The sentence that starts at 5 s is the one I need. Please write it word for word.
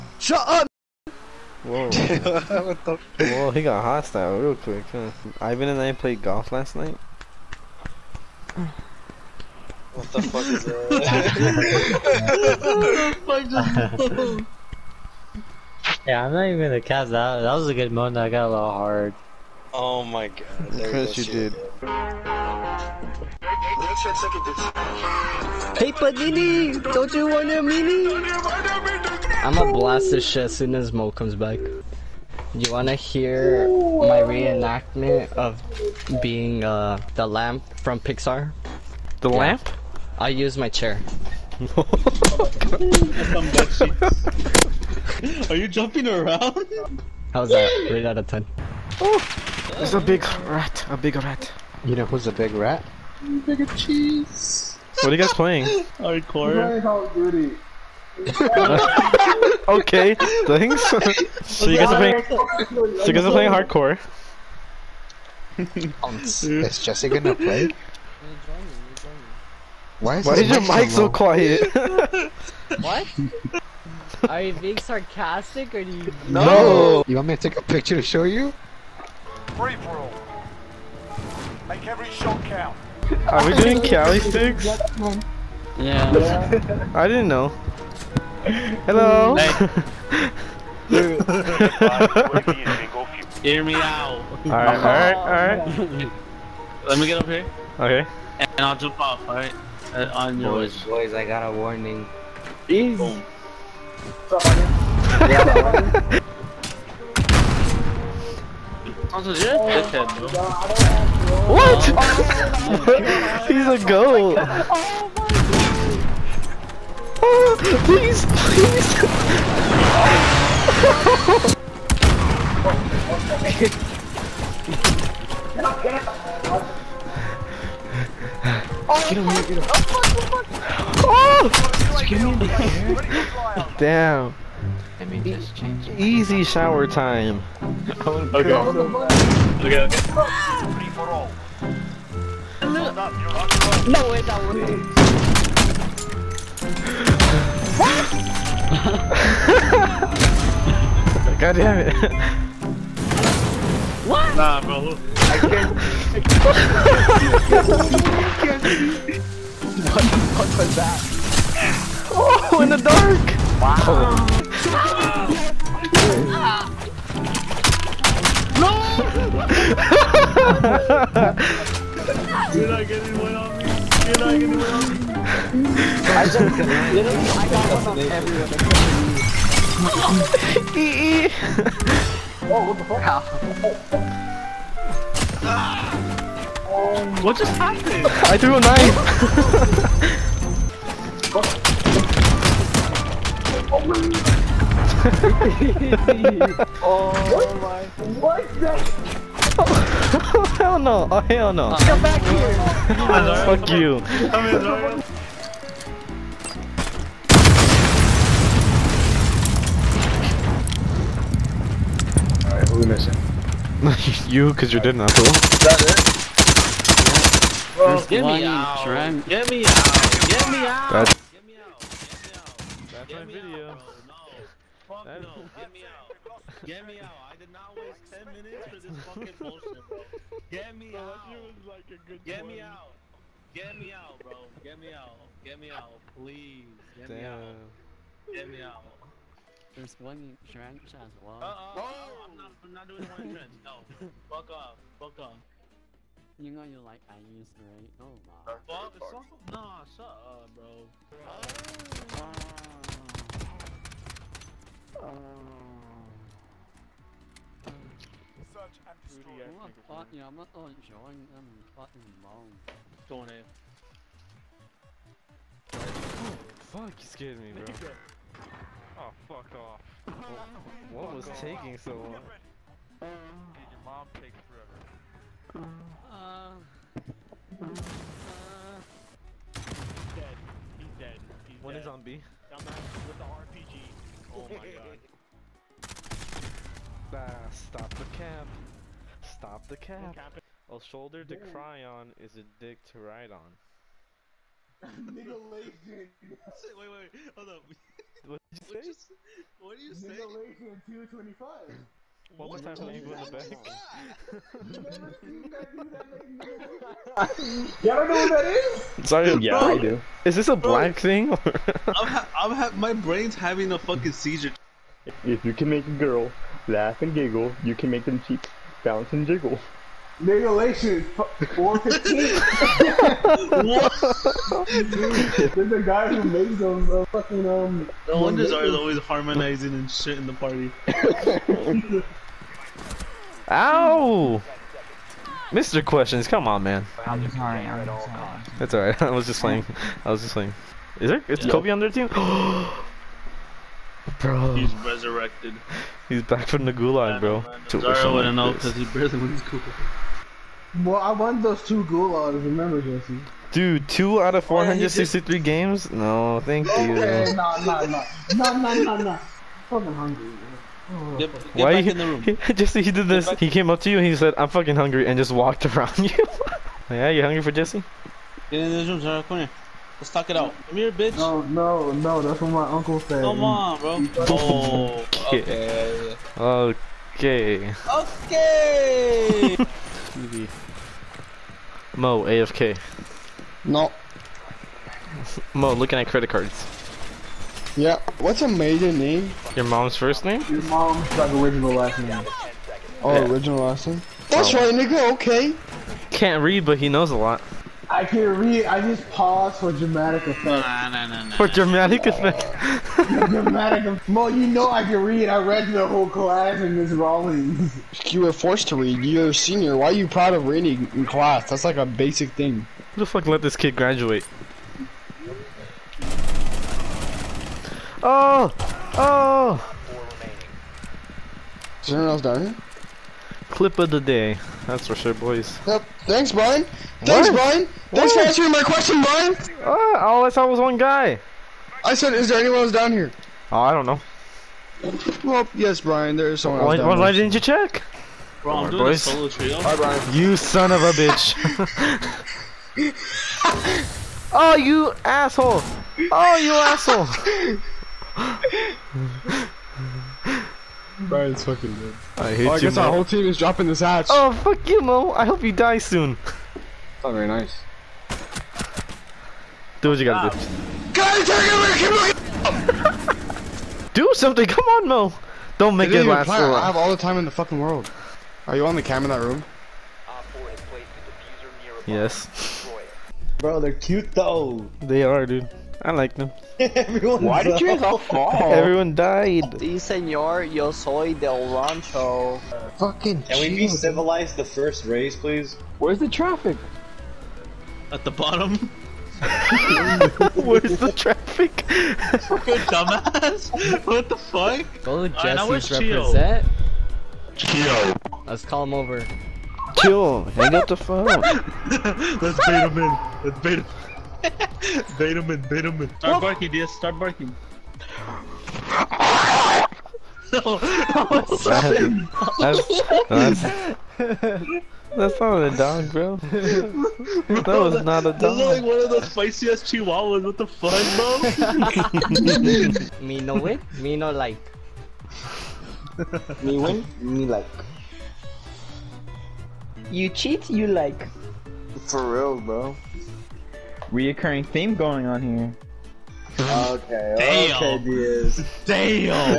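Ivan and I played golf last night.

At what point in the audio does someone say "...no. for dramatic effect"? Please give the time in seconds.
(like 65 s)
401 s.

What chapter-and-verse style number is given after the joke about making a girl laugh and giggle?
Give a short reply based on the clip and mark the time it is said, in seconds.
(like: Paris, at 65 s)
415, at 321 s.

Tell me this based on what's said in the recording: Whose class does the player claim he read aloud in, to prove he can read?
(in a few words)
Miss Rawlings.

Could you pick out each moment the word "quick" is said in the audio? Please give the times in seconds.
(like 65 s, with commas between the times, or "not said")
4 s.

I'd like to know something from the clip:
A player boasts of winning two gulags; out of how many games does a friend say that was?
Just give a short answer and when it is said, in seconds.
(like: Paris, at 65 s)
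463, at 354 s.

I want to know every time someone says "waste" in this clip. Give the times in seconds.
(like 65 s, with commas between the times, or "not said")
227 s.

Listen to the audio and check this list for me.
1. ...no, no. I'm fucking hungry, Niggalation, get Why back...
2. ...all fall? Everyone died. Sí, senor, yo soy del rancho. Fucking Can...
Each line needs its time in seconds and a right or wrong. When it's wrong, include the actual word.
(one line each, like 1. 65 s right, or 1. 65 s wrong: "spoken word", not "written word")
1. 358 s wrong: "Get", not "Niggalation"
2. 477 s right.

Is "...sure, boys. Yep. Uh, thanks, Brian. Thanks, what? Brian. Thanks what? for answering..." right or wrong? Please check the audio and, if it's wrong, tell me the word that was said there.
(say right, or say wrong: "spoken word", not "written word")
right.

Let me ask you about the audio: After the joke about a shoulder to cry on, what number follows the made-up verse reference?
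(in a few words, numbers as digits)
225.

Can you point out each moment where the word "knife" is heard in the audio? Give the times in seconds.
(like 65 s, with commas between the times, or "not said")
193 s.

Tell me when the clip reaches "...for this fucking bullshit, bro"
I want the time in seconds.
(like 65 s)
228 s.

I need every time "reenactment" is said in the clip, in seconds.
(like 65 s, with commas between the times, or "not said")
34 s.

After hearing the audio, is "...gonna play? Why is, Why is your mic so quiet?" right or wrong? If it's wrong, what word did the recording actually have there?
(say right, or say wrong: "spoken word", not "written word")
right.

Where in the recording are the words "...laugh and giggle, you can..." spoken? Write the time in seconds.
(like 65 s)
316 s.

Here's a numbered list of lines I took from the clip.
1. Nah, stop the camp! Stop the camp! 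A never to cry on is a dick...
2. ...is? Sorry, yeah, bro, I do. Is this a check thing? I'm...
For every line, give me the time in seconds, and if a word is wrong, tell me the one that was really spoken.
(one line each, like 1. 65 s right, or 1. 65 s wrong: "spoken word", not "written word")
1. 287 s wrong: "shoulder", not "never"
2. 308 s wrong: "black", not "check".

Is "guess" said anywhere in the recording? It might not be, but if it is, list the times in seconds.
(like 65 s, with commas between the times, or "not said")
452 s.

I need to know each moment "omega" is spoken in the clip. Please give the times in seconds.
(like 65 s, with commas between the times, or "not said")
not said.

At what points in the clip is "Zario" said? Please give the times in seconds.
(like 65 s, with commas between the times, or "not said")
347 s, 368 s.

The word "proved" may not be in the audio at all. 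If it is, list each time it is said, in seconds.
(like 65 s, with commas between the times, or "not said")
not said.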